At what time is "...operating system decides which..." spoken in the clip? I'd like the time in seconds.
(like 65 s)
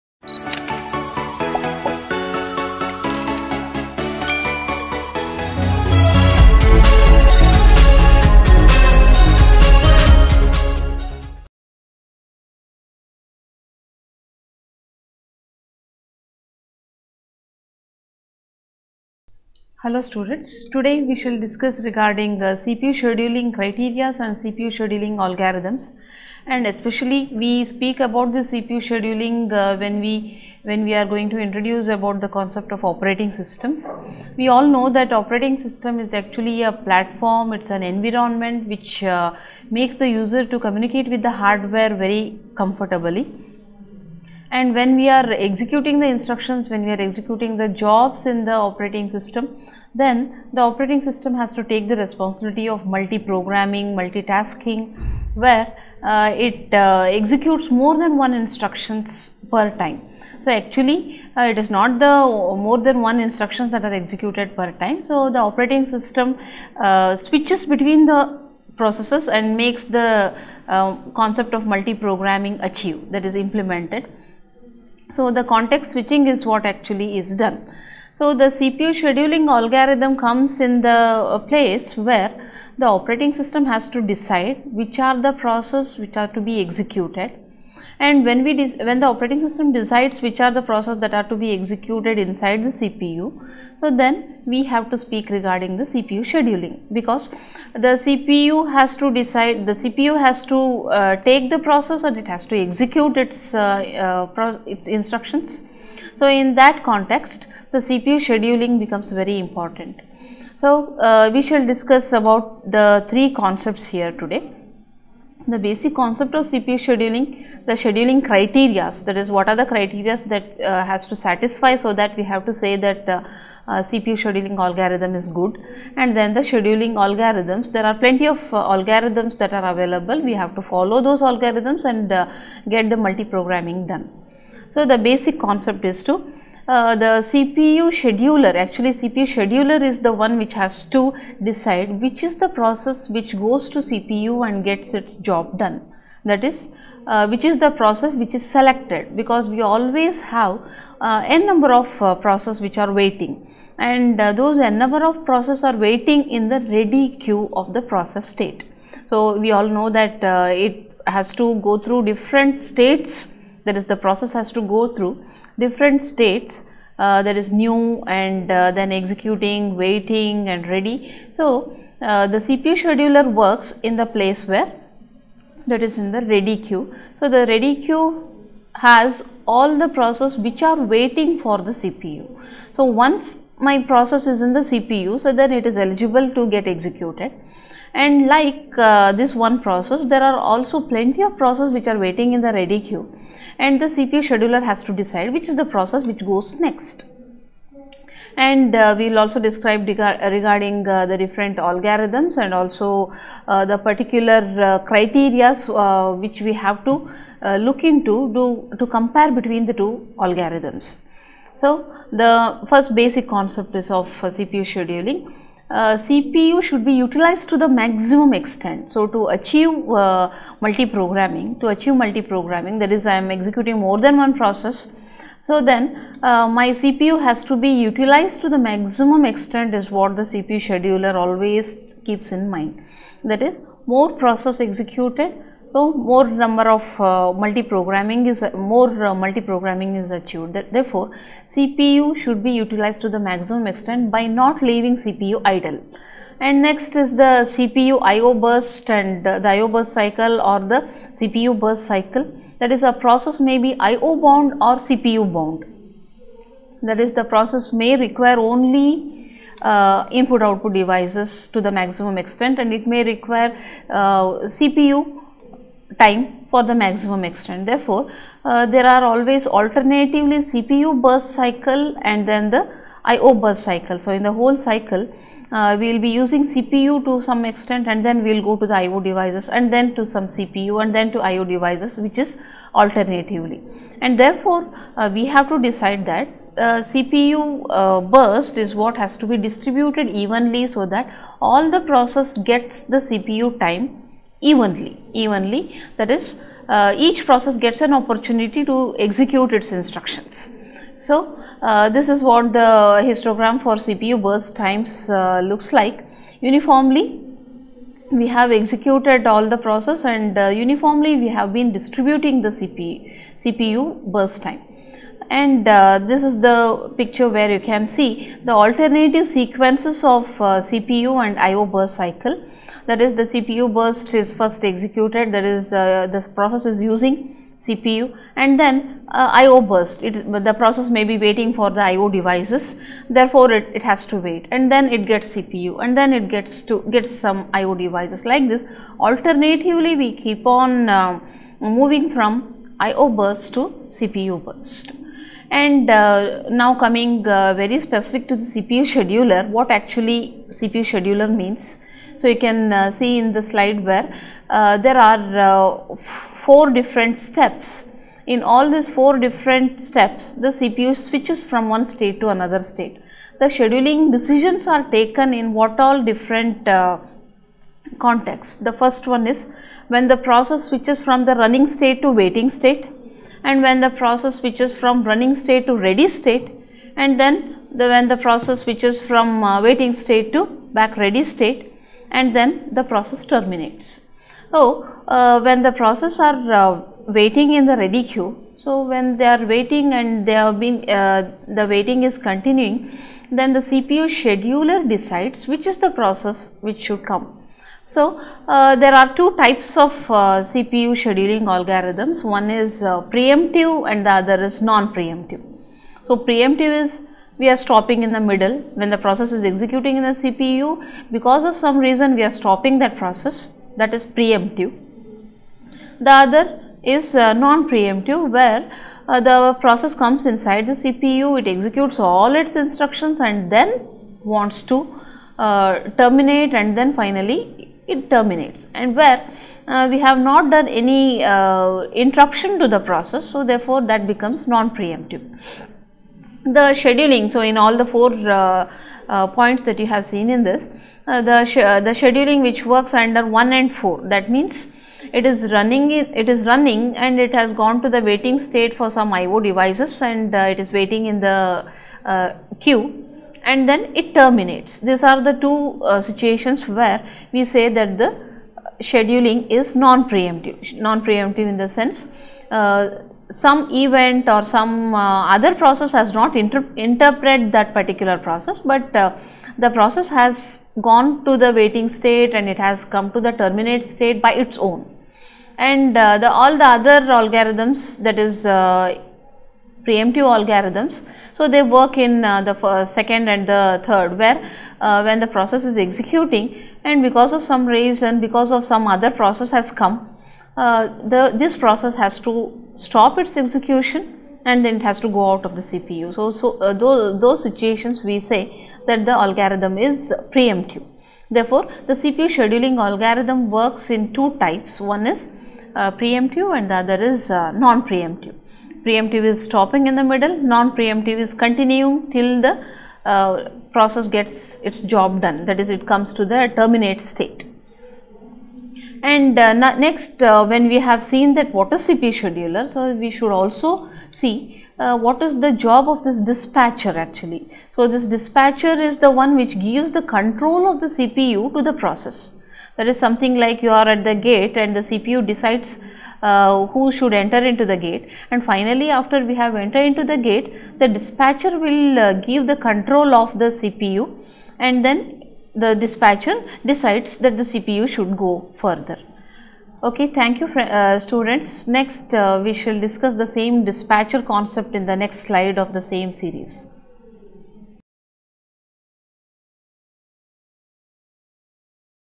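89 s.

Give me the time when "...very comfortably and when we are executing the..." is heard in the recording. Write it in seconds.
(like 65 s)
41 s.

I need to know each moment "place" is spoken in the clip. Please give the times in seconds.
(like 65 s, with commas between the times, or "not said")
81 s, 174 s.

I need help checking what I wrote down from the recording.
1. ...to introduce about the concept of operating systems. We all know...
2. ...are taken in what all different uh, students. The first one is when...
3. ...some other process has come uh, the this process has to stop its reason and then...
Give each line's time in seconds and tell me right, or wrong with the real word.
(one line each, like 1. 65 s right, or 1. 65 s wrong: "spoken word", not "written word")
1. 31 s right
2. 364 s wrong: "contexts", not "students"
3. 488 s wrong: "execution", not "reason".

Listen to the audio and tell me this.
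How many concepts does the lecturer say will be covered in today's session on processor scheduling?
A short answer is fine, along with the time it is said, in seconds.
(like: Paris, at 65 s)
3, at 113 s.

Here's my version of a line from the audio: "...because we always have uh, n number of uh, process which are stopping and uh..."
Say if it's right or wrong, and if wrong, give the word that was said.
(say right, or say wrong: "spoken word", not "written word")
wrong: "waiting", not "stopping".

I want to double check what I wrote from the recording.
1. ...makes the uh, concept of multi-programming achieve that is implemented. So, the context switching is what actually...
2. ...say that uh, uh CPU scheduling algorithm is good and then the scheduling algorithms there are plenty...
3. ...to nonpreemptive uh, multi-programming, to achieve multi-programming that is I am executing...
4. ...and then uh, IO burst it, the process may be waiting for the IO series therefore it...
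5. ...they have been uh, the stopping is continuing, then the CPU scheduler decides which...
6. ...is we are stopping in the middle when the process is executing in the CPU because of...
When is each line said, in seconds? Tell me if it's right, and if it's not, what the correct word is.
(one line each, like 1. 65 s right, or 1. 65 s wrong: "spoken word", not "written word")
1. 69 s right
2. 122 s right
3. 219 s wrong: "achieve", not "nonpreemptive"
4. 328 s wrong: "devices", not "series"
5. 390 s wrong: "waiting", not "stopping"
6. 406 s right.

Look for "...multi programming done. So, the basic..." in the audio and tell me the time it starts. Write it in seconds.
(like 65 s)
132 s.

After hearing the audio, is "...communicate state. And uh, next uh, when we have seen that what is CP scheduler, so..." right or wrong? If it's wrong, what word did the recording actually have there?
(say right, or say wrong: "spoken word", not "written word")
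wrong: "terminate", not "communicate".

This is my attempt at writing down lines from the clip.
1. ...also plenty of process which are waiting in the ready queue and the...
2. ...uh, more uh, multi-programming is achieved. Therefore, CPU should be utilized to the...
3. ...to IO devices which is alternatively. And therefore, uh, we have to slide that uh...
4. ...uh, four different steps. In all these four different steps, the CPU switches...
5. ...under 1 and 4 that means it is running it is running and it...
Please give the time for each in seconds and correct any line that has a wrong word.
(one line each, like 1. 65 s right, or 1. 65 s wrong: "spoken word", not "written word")
1. 190 s right
2. 238 s right
3. 281 s wrong: "decide", not "slide"
4. 355 s right
5. 442 s right.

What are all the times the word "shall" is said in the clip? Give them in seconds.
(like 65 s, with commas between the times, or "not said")
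21 s, 111 s, 552 s.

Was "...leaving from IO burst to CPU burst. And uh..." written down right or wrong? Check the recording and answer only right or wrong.
wrong.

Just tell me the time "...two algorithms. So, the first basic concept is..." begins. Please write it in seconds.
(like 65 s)
209 s.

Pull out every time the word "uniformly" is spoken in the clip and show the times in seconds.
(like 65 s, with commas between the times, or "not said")
306 s, 310 s.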